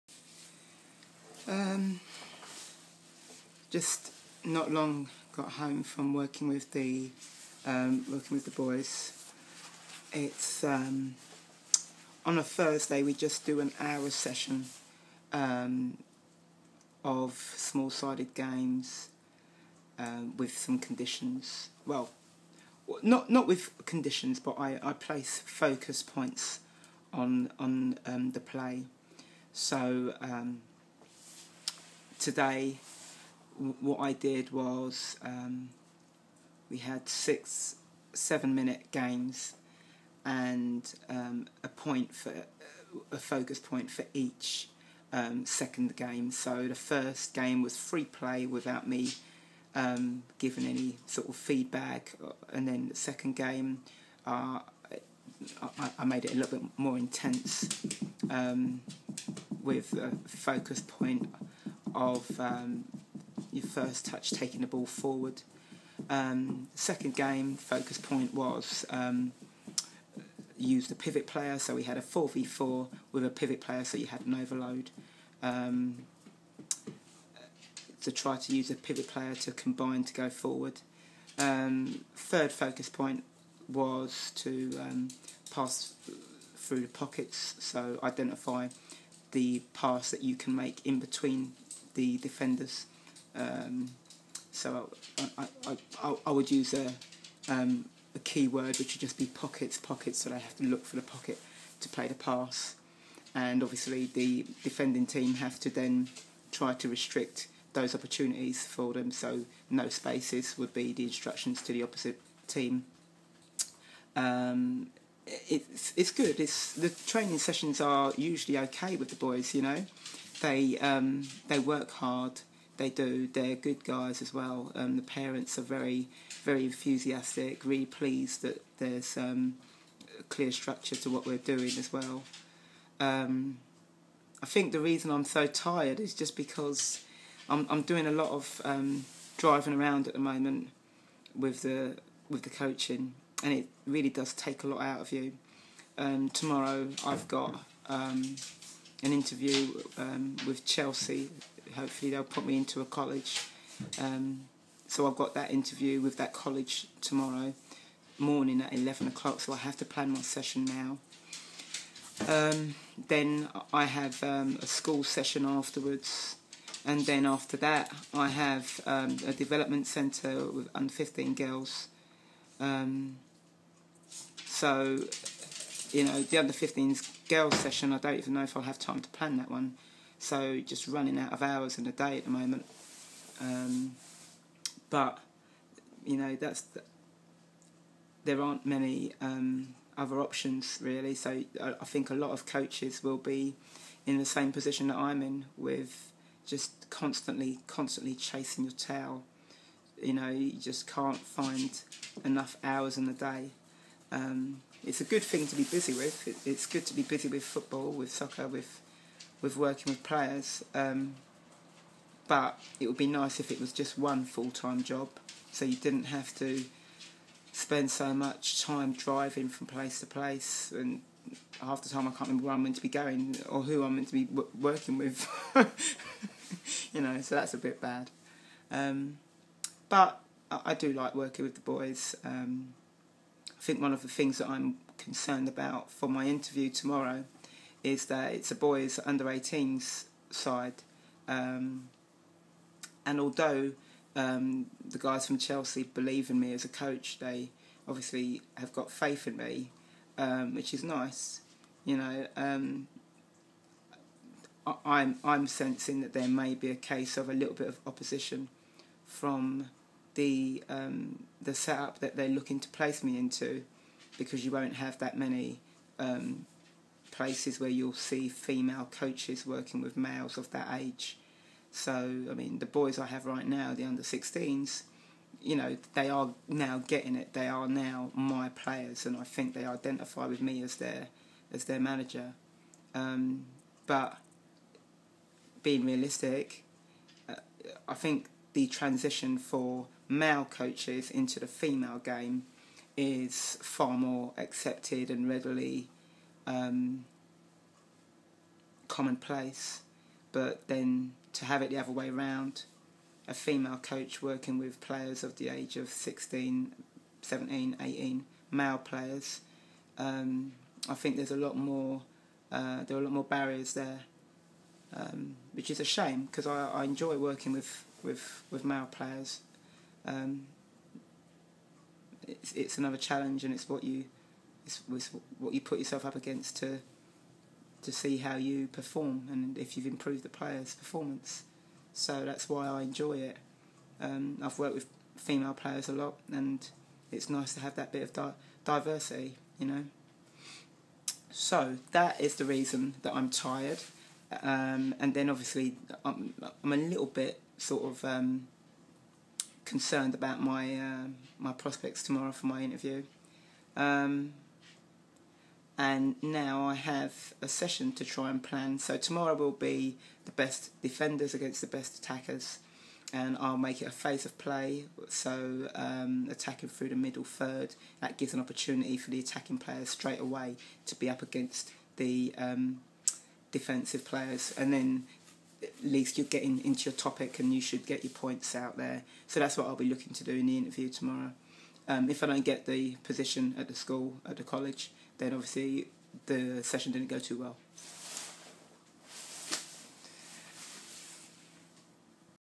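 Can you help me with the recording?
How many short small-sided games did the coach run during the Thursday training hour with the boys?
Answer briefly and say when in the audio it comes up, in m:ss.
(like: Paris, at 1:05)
6, at 0:37.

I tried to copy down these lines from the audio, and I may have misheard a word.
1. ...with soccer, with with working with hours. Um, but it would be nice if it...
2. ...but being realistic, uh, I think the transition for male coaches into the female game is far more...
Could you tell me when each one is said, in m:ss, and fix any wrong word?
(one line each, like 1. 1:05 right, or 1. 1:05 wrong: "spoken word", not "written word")
1. 3:27 wrong: "players", not "hours"
2. 4:43 right.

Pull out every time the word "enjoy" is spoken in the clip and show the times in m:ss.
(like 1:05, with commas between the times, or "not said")
5:16, 5:32.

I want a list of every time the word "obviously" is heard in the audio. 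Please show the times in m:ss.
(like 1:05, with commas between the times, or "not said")
1:43, 4:07, 5:45, 6:25.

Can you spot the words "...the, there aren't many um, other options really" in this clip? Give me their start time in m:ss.
3:06.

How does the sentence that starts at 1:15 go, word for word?
Um, to try to use a pivot player to combine to go forward.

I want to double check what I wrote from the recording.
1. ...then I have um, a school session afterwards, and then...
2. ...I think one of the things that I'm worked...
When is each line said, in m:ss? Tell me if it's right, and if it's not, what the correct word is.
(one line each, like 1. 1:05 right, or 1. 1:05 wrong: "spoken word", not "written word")
1. 2:43 right
2. 3:53 wrong: "concerned", not "worked".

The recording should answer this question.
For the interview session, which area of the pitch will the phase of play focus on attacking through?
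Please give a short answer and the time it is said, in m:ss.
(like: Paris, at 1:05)
middle third, at 6:06.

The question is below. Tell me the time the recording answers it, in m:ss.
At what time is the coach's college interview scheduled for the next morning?
2:38.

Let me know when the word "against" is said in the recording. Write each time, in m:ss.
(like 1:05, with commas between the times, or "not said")
5:26, 6:01, 6:11.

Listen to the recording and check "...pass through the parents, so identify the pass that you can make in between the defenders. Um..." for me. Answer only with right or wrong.
wrong.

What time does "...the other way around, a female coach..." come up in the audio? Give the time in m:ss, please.
5:01.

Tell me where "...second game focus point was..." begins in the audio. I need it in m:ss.
1:06.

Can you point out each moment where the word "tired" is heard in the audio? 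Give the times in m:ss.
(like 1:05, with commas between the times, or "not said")
2:15, 5:43.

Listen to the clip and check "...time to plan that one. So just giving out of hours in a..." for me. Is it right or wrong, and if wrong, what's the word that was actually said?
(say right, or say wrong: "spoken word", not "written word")
wrong: "running", not "giving".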